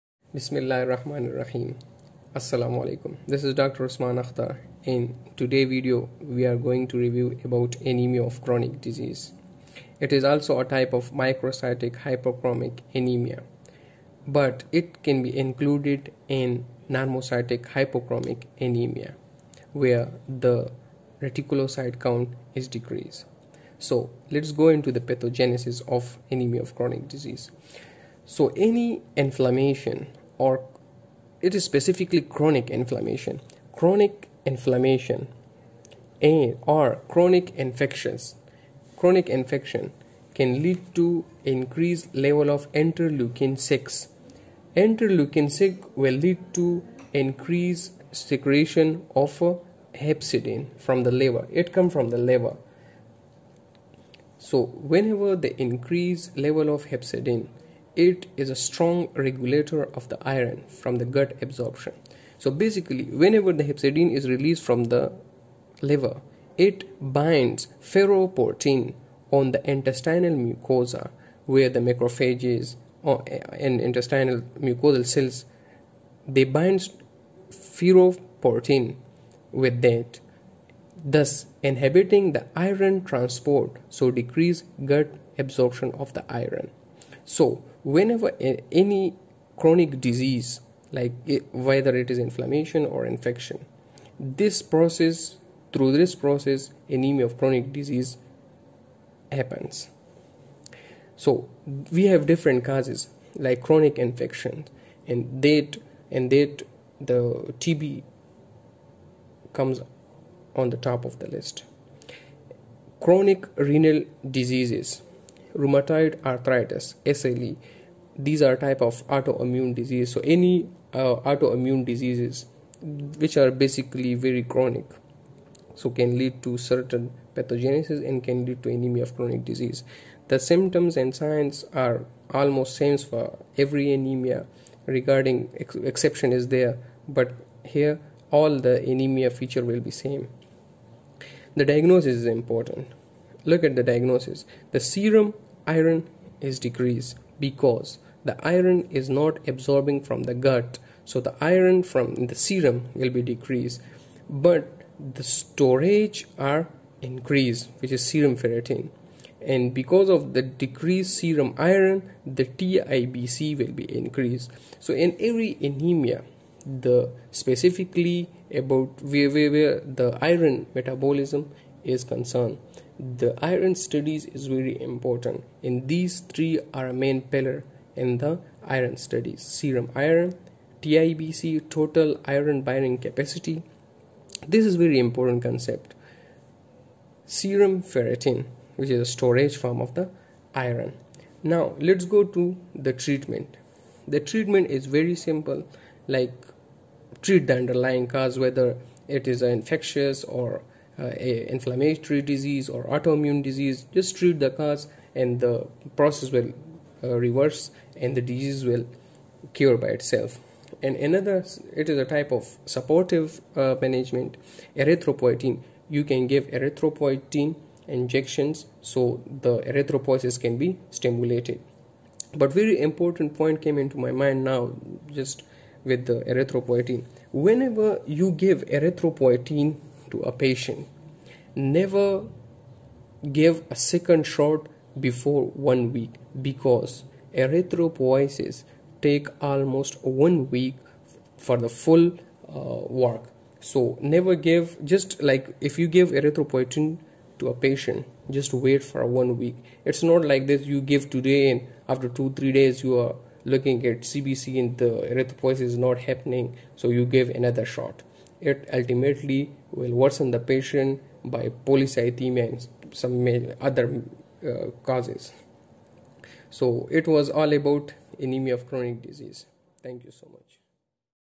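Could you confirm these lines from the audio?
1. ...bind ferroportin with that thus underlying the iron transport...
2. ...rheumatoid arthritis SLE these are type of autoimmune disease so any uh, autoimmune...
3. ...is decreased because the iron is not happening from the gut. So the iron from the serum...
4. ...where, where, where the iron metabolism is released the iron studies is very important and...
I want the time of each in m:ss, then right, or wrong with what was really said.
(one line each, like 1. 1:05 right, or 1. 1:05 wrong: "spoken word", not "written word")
1. 1:16 wrong: "inhibiting", not "underlying"
2. 1:55 right
3. 2:26 wrong: "absorbing", not "happening"
4. 2:49 wrong: "concerned", not "released".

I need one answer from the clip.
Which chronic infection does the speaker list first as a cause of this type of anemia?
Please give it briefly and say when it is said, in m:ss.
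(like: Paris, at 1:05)
TB, at 1:47.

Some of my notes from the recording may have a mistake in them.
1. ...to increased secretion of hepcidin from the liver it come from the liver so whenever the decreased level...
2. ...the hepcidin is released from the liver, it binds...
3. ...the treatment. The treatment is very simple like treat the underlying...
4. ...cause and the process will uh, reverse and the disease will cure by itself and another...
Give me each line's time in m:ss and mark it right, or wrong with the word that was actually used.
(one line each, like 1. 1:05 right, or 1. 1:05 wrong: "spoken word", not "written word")
1. 0:46 wrong: "increased", not "decreased"
2. 1:03 right
3. 3:12 right
4. 3:24 right.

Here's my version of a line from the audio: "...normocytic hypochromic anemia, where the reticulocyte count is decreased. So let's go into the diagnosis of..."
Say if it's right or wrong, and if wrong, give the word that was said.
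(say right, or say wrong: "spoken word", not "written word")
wrong: "pathogenesis", not "diagnosis".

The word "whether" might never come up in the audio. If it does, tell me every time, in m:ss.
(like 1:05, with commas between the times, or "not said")
1:31, 3:18.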